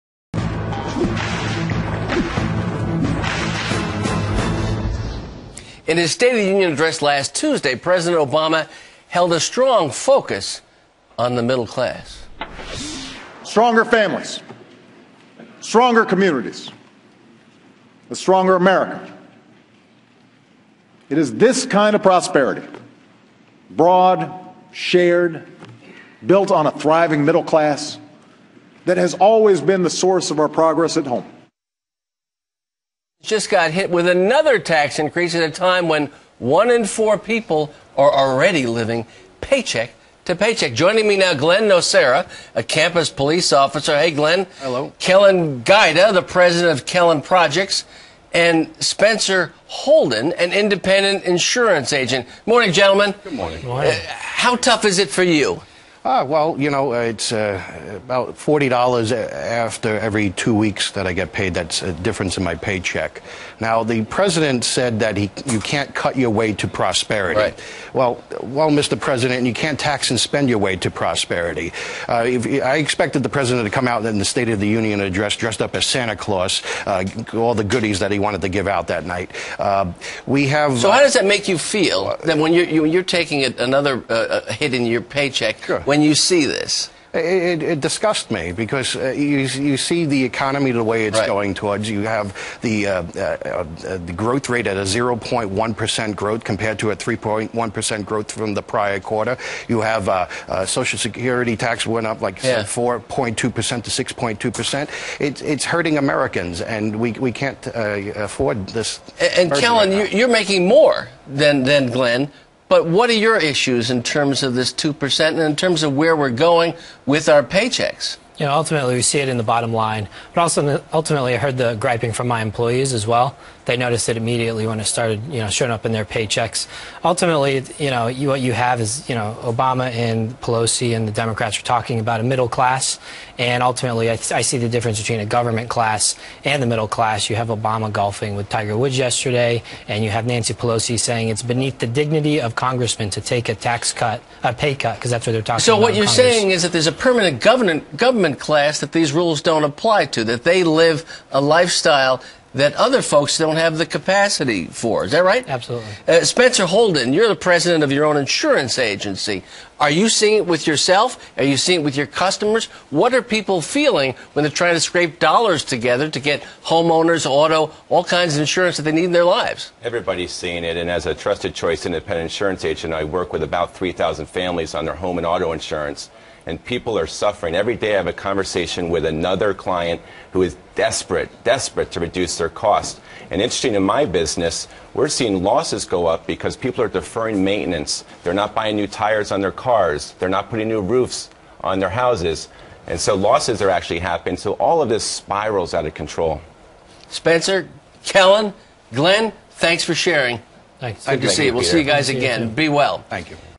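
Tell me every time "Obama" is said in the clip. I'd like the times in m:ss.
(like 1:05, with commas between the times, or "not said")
0:08, 2:09, 2:17.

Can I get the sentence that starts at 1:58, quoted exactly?
you know, ultimately we see it in the bottom line.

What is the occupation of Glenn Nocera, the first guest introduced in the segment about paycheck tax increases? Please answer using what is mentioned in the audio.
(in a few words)
campus police officer.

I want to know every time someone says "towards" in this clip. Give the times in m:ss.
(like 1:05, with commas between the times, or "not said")
1:31.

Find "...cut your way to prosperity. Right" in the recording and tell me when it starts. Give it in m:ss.
1:05.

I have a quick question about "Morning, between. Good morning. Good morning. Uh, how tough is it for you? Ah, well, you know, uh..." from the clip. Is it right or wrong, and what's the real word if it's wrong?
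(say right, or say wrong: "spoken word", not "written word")
wrong: "gentlemen", not "between".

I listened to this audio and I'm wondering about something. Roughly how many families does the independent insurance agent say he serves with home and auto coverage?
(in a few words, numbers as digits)
3,000.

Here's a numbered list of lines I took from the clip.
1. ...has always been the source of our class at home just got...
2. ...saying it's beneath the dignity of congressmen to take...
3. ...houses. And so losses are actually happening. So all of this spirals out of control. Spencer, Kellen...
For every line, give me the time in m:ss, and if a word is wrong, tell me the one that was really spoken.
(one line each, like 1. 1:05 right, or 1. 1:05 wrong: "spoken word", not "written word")
1. 0:28 wrong: "progress", not "class"
2. 2:20 right
3. 3:12 right.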